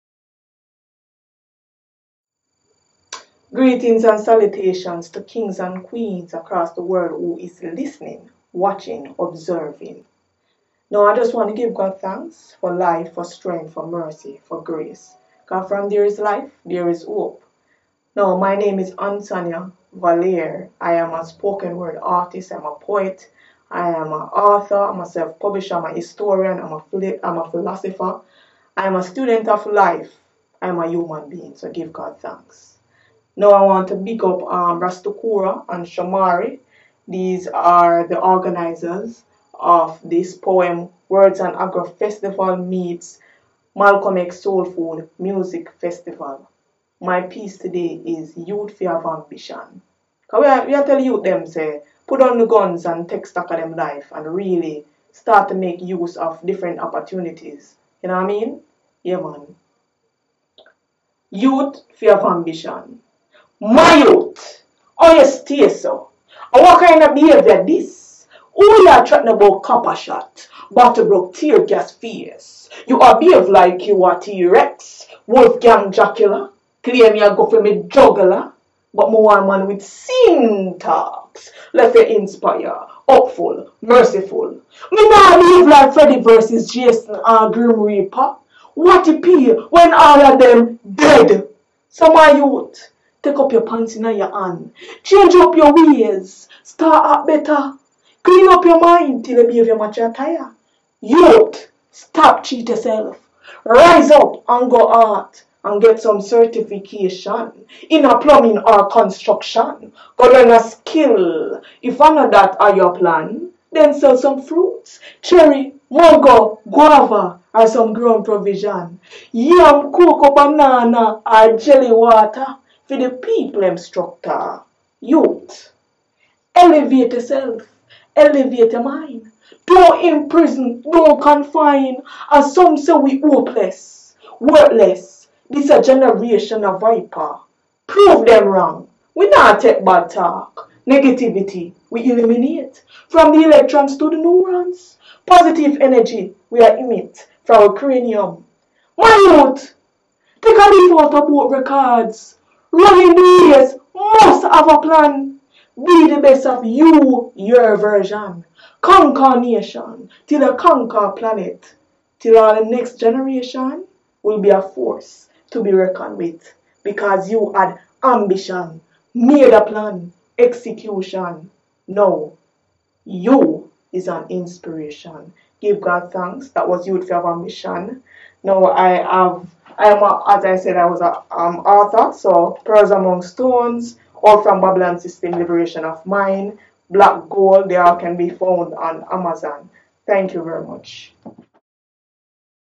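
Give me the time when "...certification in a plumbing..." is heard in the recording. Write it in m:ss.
1:46.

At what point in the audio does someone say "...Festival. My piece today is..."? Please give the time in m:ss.
0:45.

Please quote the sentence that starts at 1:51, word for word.
If none of that are your plan, then sell some fruits, cherry, mango, guava, or some ground provision.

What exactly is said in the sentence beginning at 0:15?
God, from there is life, there is hope.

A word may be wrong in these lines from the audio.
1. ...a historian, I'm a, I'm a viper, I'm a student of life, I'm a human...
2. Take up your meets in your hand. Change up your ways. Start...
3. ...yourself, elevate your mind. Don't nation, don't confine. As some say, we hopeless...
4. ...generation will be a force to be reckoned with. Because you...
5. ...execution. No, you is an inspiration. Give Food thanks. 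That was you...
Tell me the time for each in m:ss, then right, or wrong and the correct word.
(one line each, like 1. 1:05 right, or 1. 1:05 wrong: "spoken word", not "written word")
1. 0:25 wrong: "philosopher", not "viper"
2. 1:33 wrong: "pants", not "meets"
3. 2:07 wrong: "imprison", not "nation"
4. 2:42 right
5. 2:50 wrong: "God", not "Food".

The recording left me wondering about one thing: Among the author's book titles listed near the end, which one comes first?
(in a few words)
Pearls Among Stones.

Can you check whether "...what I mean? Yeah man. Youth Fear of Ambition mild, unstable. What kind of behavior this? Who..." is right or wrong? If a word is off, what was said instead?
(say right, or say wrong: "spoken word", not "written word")
right.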